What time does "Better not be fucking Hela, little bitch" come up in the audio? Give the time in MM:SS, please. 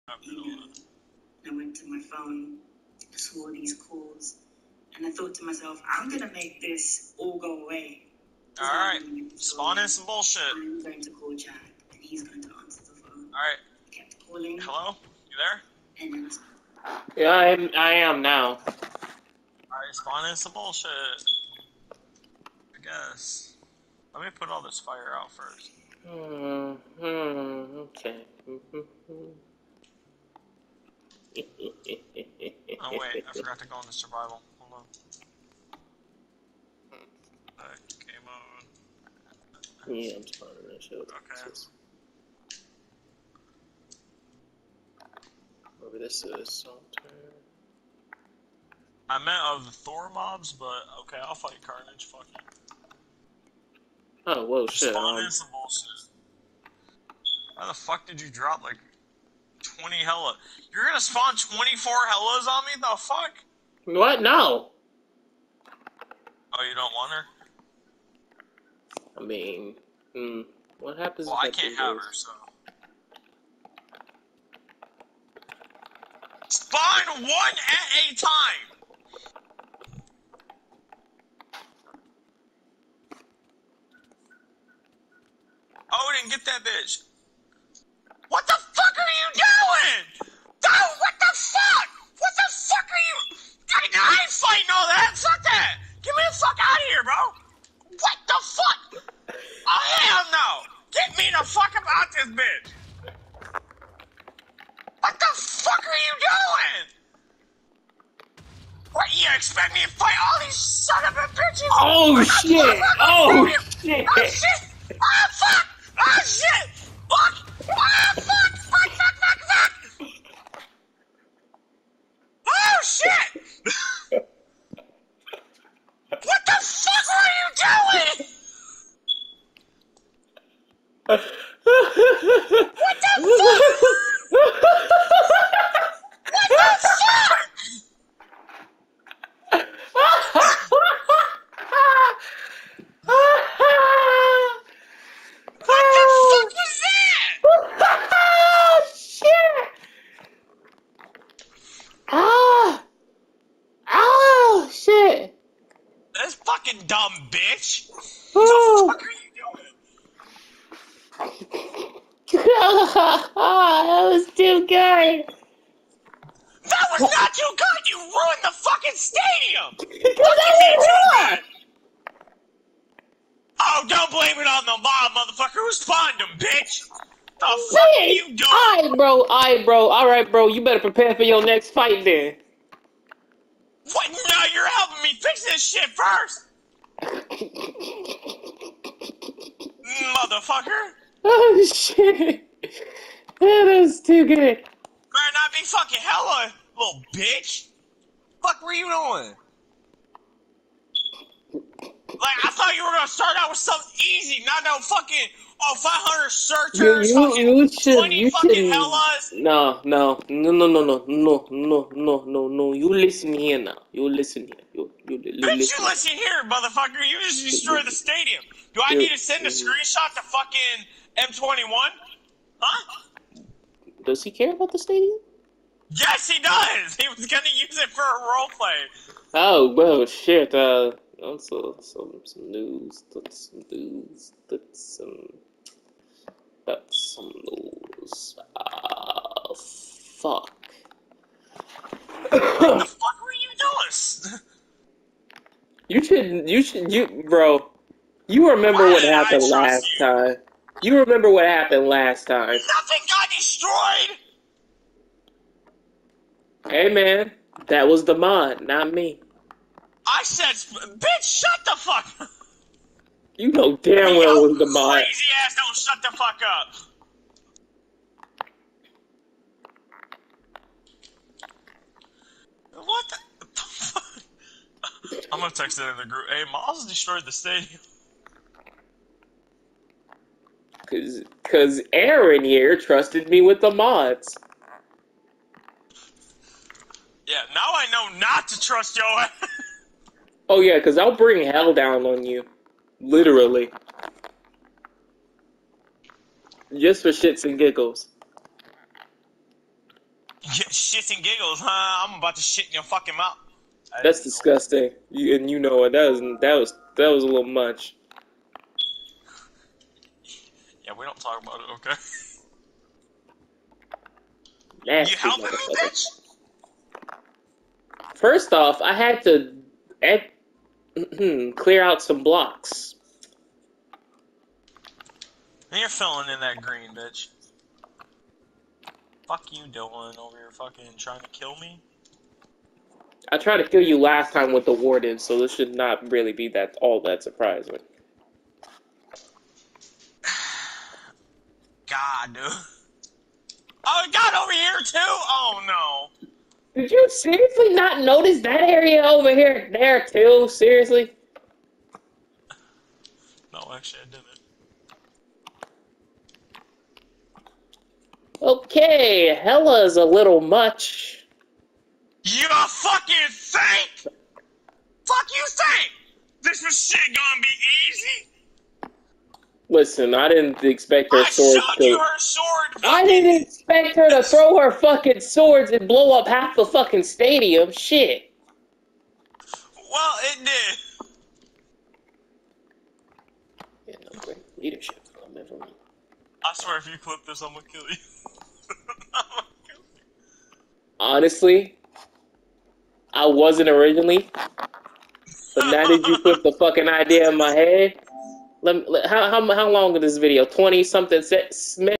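03:14.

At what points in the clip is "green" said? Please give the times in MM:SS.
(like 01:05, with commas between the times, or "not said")
05:26.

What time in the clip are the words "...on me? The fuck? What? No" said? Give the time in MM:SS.
01:02.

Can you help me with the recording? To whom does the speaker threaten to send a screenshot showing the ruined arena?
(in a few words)
M21.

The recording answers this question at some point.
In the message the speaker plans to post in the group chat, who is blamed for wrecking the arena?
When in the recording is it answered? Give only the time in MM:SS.
04:36.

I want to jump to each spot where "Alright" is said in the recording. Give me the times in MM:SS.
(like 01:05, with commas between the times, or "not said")
00:18.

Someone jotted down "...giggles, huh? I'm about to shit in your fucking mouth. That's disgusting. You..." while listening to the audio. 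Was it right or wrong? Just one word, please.
right.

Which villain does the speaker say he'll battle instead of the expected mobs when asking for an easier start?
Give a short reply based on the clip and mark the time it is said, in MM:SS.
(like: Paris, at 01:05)
Carnage, at 00:51.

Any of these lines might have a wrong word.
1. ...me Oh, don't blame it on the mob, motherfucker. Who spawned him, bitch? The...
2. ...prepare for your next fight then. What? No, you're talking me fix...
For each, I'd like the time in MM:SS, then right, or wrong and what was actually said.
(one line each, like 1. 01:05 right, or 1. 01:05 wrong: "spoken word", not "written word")
1. 02:51 right
2. 03:00 wrong: "helping", not "talking".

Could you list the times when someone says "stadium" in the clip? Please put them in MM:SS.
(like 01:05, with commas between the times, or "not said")
02:48, 03:37, 03:44, 04:37, 06:17.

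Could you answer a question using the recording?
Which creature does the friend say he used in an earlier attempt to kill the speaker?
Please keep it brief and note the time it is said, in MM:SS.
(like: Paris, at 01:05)
The warden, at 05:34.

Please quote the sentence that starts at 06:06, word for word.
This was shit gonna be easy?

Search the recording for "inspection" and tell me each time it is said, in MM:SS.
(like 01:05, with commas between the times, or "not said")
not said.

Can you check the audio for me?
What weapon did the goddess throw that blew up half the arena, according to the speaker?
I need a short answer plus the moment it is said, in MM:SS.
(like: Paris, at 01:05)
Swords, at 06:15.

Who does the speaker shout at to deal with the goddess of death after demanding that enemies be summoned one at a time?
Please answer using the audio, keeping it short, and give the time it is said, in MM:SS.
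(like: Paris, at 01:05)
Odin, at 01:25.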